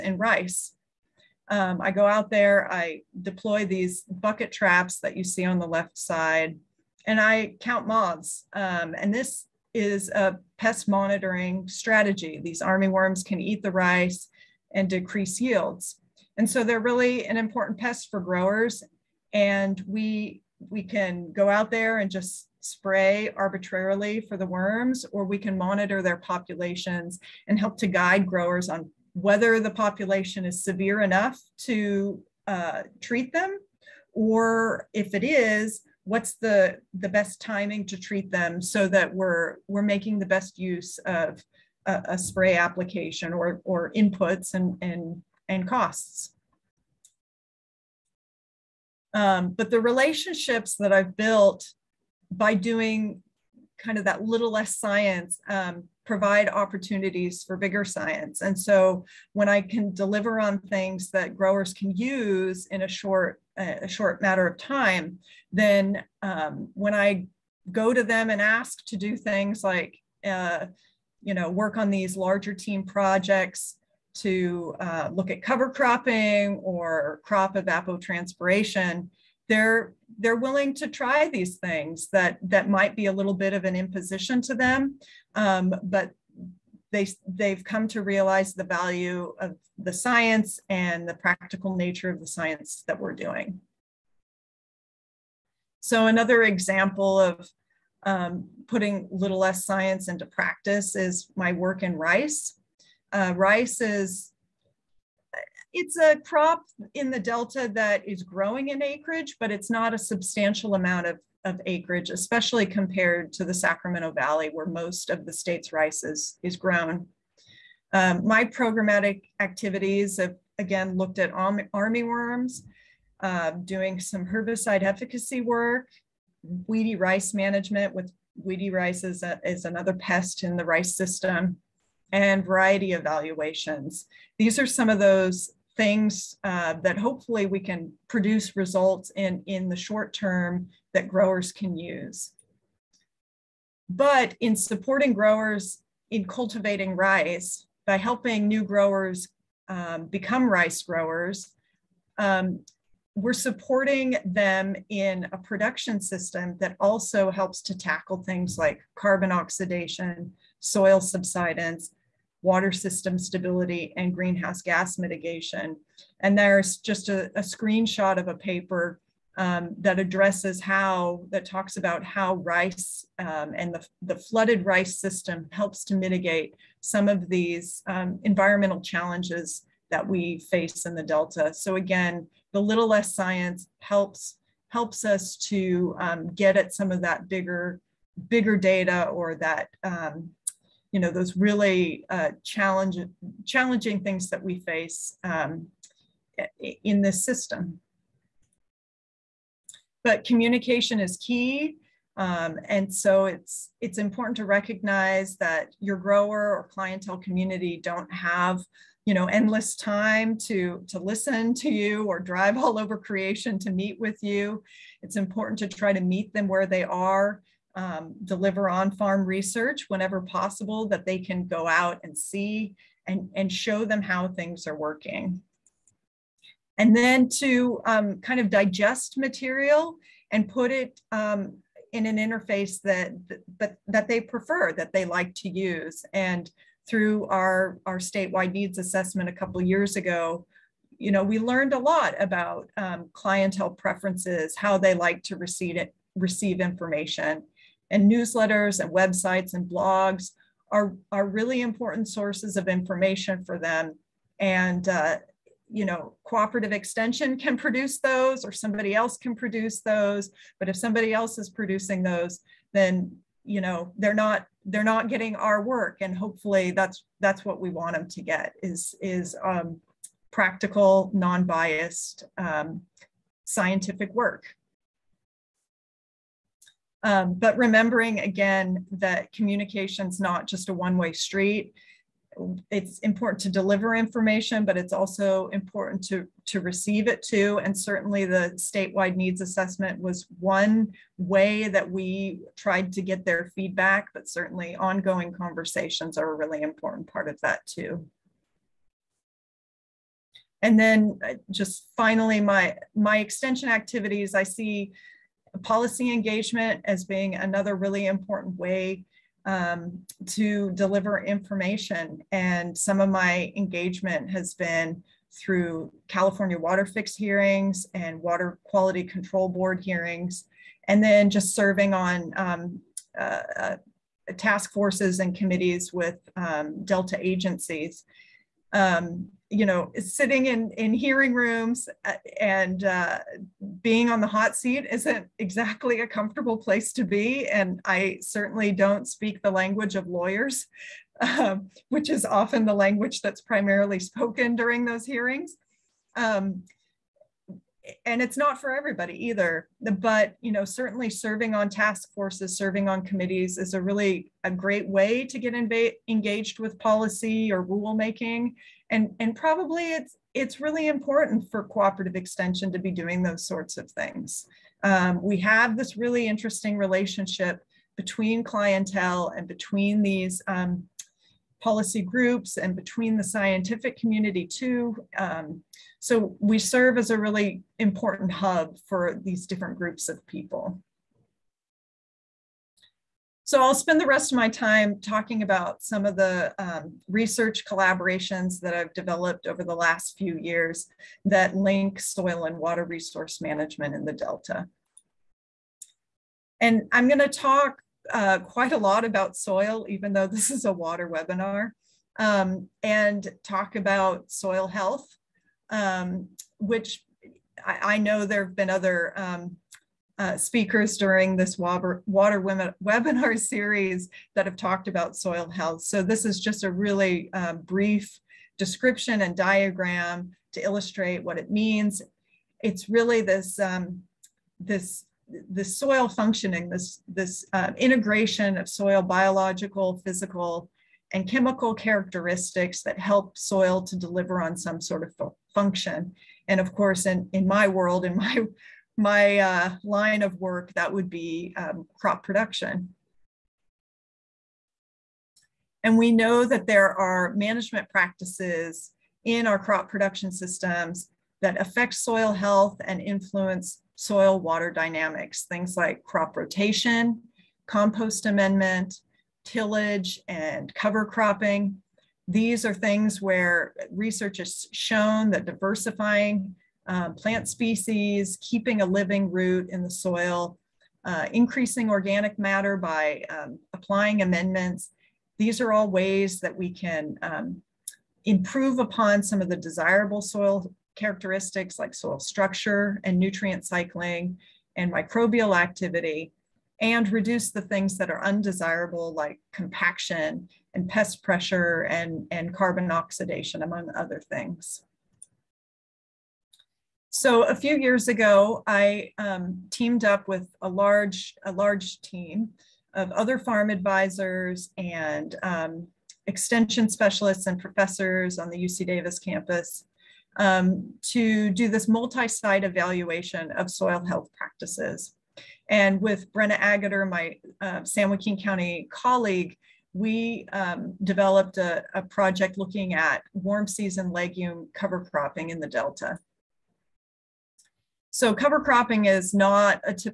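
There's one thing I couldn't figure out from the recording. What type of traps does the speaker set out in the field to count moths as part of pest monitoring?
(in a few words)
bucket traps.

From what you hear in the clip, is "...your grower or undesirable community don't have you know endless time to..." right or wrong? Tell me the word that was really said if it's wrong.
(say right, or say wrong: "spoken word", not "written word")
wrong: "clientele", not "undesirable".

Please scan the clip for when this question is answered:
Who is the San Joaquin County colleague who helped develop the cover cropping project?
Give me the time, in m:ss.
8:36.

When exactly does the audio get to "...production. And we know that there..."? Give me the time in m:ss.
7:22.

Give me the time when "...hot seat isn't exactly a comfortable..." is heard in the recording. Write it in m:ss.
5:34.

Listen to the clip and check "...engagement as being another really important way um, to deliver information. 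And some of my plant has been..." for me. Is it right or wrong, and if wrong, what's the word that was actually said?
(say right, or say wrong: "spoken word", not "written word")
wrong: "engagement", not "plant".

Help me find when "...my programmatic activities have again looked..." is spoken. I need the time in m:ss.
1:58.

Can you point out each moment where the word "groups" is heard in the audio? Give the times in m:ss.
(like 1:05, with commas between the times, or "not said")
6:12, 6:19.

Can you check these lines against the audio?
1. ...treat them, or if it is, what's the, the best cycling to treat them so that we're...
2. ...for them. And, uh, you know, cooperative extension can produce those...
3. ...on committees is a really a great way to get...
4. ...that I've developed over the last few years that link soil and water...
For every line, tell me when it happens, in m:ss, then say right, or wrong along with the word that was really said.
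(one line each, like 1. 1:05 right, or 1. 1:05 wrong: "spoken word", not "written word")
1. 0:33 wrong: "timing", not "cycling"
2. 4:13 right
3. 5:52 right
4. 6:28 right.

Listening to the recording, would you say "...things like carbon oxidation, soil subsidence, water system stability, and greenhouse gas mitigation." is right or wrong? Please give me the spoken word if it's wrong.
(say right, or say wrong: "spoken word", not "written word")
right.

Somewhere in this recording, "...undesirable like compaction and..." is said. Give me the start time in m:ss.
8:08.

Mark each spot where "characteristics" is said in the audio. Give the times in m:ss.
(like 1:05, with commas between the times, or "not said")
7:11, 8:00.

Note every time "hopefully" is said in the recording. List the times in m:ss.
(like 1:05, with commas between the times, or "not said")
2:16, 4:26.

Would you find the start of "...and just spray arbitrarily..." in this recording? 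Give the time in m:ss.
0:21.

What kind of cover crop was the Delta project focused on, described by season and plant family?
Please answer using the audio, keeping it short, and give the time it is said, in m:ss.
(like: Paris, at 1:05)
warm season legume, at 8:43.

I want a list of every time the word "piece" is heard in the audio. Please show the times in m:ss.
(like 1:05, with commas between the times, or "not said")
not said.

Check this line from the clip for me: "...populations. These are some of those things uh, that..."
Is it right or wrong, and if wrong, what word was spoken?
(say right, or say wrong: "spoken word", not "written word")
wrong: "evaluations", not "populations".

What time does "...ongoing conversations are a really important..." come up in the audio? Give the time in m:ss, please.
4:54.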